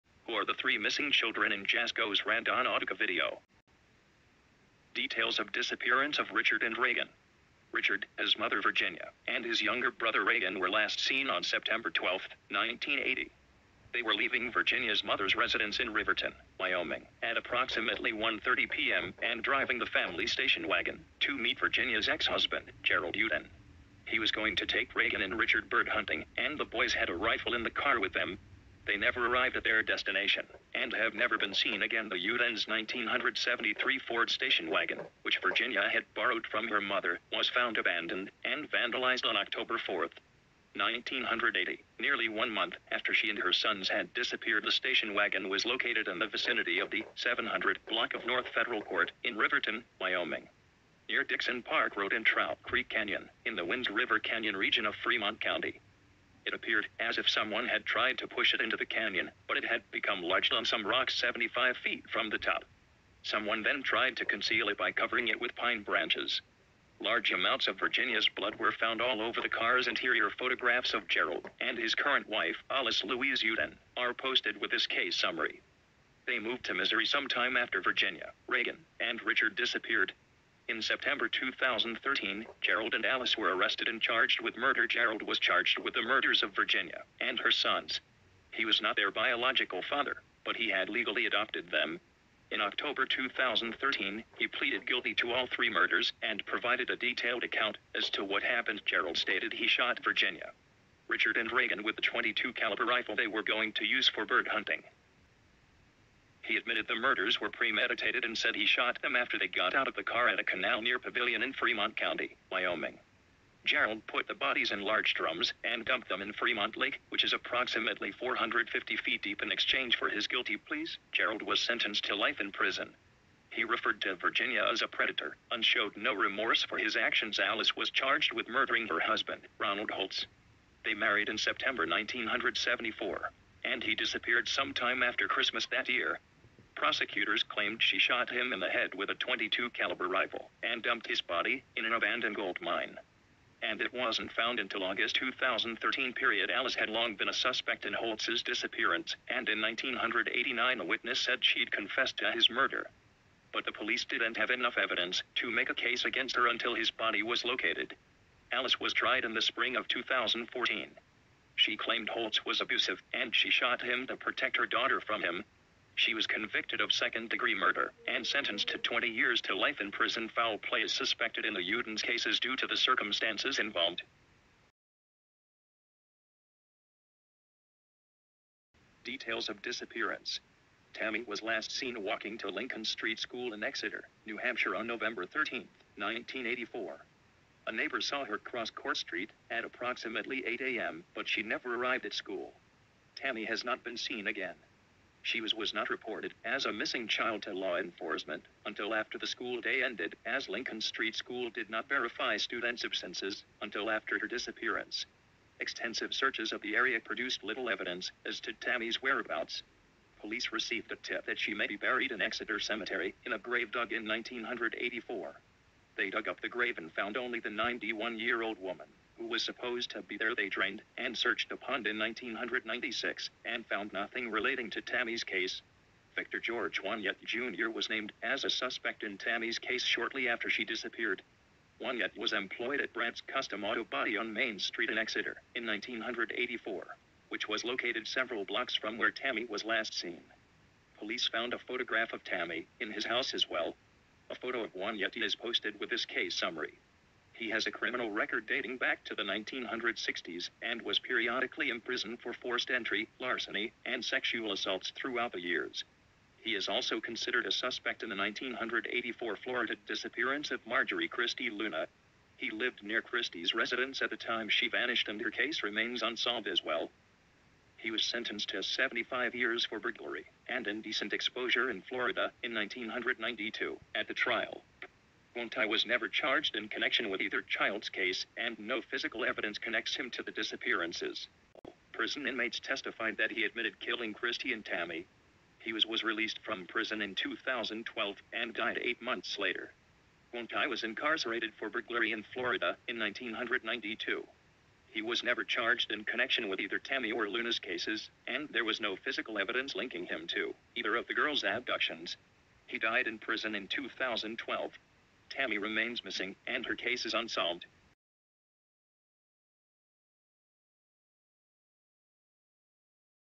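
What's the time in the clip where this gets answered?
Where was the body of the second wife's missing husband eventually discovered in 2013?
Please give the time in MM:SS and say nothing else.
02:21.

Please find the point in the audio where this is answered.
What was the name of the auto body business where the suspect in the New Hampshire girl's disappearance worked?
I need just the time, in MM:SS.
03:52.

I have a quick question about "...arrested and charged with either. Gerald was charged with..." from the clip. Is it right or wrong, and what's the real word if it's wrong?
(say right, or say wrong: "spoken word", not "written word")
wrong: "murder", not "either".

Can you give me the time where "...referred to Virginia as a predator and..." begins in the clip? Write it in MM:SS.
02:03.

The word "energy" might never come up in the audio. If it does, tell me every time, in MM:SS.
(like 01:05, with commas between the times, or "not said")
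not said.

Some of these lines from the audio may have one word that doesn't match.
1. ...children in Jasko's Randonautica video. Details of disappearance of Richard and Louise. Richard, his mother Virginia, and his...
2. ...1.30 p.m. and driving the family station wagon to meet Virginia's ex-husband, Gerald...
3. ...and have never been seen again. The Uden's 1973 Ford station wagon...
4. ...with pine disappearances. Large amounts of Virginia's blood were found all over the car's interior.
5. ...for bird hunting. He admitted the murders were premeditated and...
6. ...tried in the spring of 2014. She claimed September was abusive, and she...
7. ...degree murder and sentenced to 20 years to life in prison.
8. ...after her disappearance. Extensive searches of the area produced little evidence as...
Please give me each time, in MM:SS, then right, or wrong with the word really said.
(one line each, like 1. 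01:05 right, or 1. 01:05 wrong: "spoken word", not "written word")
1. 00:01 wrong: "Reagan", not "Louise"
2. 00:18 right
3. 00:30 right
4. 01:05 wrong: "branches", not "disappearances"
5. 01:44 right
6. 02:38 wrong: "Holtz", not "September"
7. 02:47 right
8. 03:23 right.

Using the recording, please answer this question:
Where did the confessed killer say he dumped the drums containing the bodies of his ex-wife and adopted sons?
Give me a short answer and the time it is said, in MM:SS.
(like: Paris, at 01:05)
Fremont Lake, at 01:56.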